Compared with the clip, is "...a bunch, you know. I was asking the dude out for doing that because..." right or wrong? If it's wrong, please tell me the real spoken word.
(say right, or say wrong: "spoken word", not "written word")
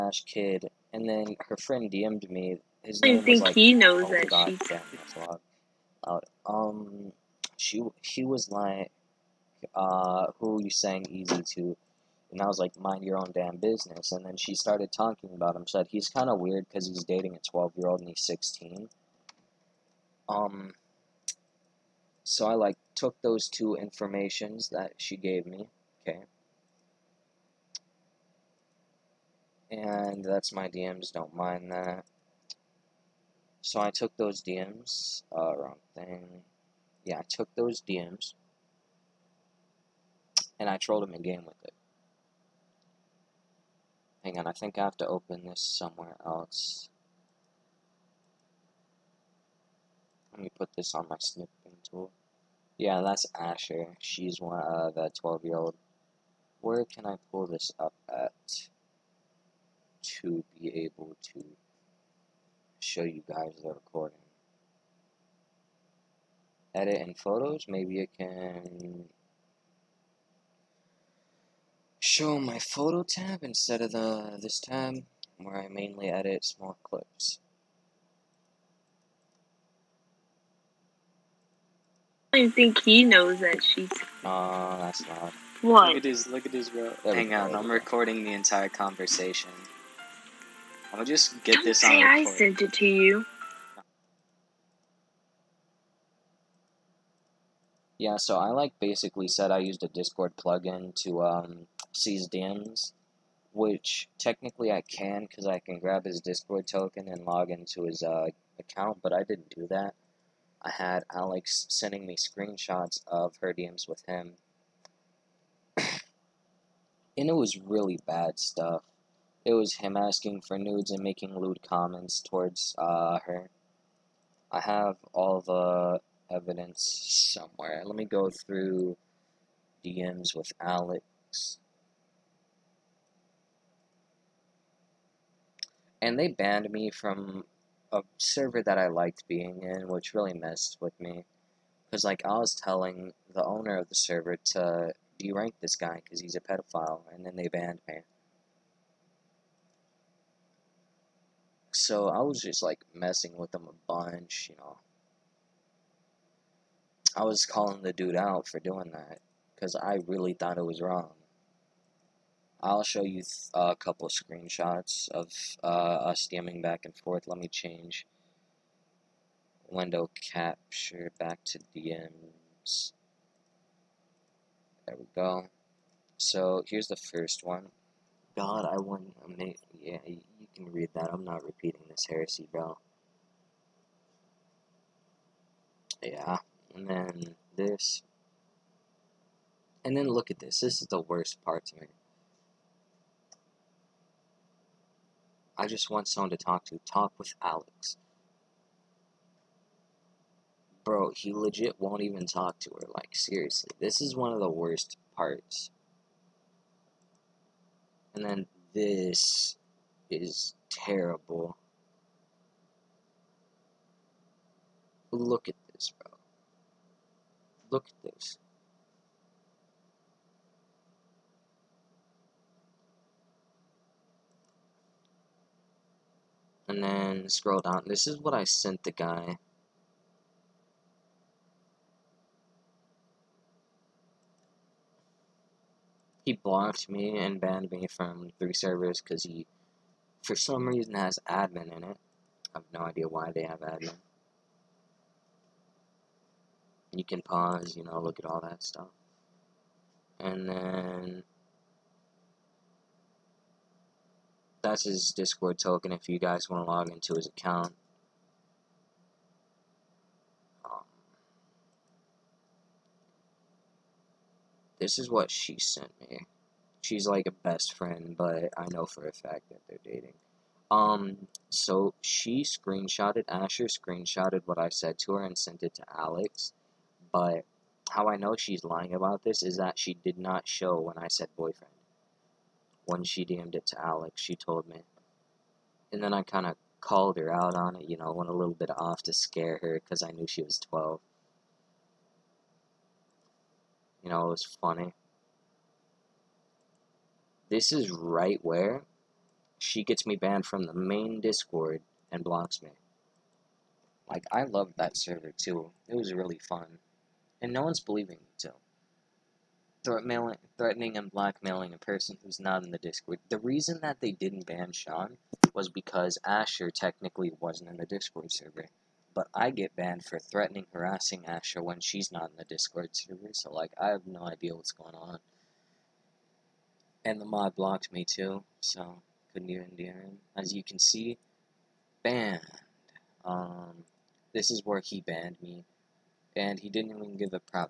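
wrong: "calling", not "asking".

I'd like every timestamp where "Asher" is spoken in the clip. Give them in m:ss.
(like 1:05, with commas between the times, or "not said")
0:53, 4:33, 5:16, 5:21.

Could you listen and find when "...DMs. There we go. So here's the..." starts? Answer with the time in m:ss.
2:51.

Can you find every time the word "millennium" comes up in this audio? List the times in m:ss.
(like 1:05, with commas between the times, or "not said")
not said.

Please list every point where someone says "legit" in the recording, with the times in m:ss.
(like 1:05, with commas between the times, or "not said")
3:21.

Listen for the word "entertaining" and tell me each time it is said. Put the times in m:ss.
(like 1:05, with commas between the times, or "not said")
not said.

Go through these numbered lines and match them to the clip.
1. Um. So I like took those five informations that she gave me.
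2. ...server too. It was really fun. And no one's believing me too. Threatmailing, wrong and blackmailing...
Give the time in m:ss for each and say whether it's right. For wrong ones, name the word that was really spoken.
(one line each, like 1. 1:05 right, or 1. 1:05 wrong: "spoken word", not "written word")
1. 0:20 wrong: "two", not "five"
2. 5:04 wrong: "threatening", not "wrong".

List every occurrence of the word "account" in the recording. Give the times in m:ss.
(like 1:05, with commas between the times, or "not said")
1:48, 4:17.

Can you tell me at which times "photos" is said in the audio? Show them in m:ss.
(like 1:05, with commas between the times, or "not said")
1:07, 1:12.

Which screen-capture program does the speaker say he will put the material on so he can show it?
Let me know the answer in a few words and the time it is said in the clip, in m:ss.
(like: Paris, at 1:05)
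Snipping tool, at 0:51.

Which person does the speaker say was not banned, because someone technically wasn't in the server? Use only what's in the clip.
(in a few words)
Sean.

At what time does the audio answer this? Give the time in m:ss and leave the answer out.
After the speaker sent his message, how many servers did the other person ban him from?
3:58.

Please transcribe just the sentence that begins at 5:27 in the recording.
And the mod blocked me too, so couldn't even do it.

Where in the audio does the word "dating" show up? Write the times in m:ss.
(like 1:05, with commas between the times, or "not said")
0:17, 4:29.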